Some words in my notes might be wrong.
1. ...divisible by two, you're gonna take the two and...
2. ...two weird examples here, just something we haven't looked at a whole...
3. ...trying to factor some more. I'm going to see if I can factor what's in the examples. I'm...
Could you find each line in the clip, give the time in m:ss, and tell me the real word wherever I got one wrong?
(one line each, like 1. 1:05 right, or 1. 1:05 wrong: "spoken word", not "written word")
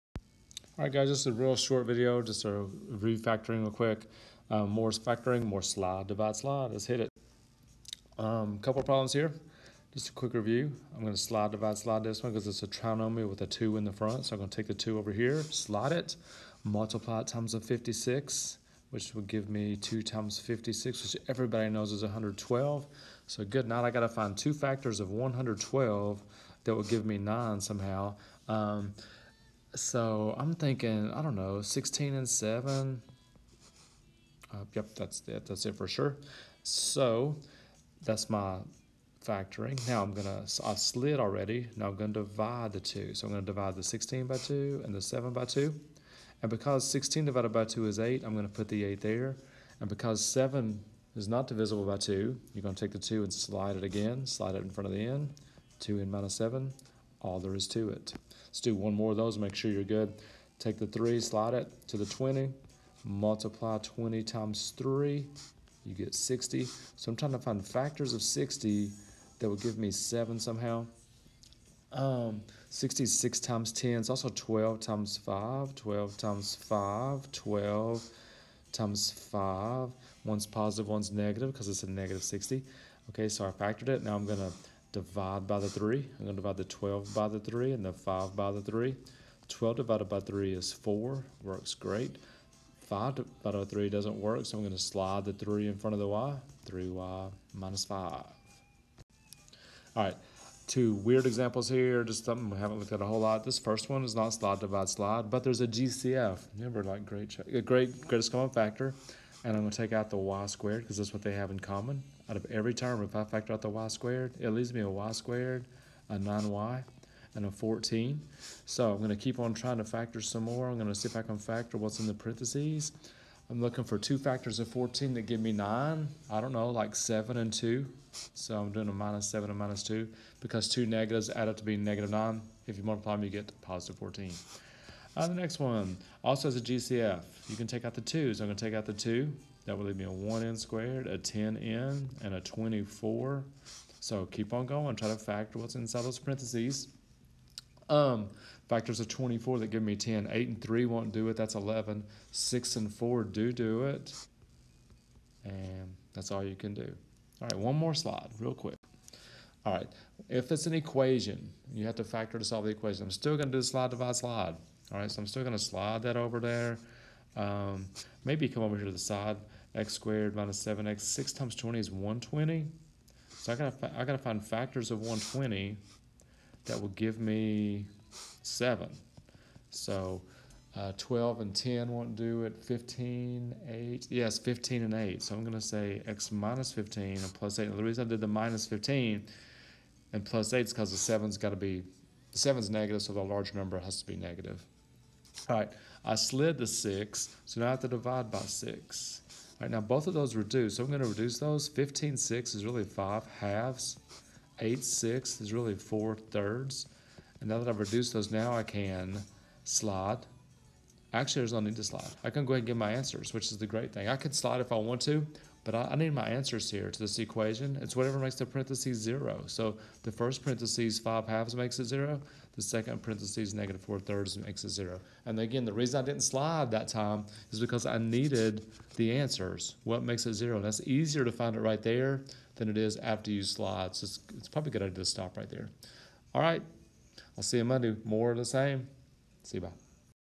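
1. 0:51 right
2. 1:40 right
3. 1:59 wrong: "parentheses", not "examples".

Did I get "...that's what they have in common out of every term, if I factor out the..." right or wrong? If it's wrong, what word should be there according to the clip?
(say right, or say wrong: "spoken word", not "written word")
right.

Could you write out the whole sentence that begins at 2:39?
All right, if it's an equation, you have to factor to solve the equation.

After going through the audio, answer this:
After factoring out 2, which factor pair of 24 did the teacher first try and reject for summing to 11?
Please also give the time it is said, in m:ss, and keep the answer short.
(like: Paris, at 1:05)
8 and 3, at 2:30.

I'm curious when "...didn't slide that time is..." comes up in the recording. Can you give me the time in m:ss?
3:46.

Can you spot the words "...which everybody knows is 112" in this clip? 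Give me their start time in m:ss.
0:21.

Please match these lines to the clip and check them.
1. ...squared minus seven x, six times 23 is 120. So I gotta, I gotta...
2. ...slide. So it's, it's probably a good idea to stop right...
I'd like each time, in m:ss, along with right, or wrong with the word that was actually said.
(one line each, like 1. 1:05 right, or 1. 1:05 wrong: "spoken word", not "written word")
1. 2:49 wrong: "20", not "23"
2. 3:53 right.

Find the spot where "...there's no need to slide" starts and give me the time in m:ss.
3:31.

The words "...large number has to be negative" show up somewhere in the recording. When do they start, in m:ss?
3:13.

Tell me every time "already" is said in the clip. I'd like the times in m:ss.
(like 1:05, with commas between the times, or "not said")
0:41.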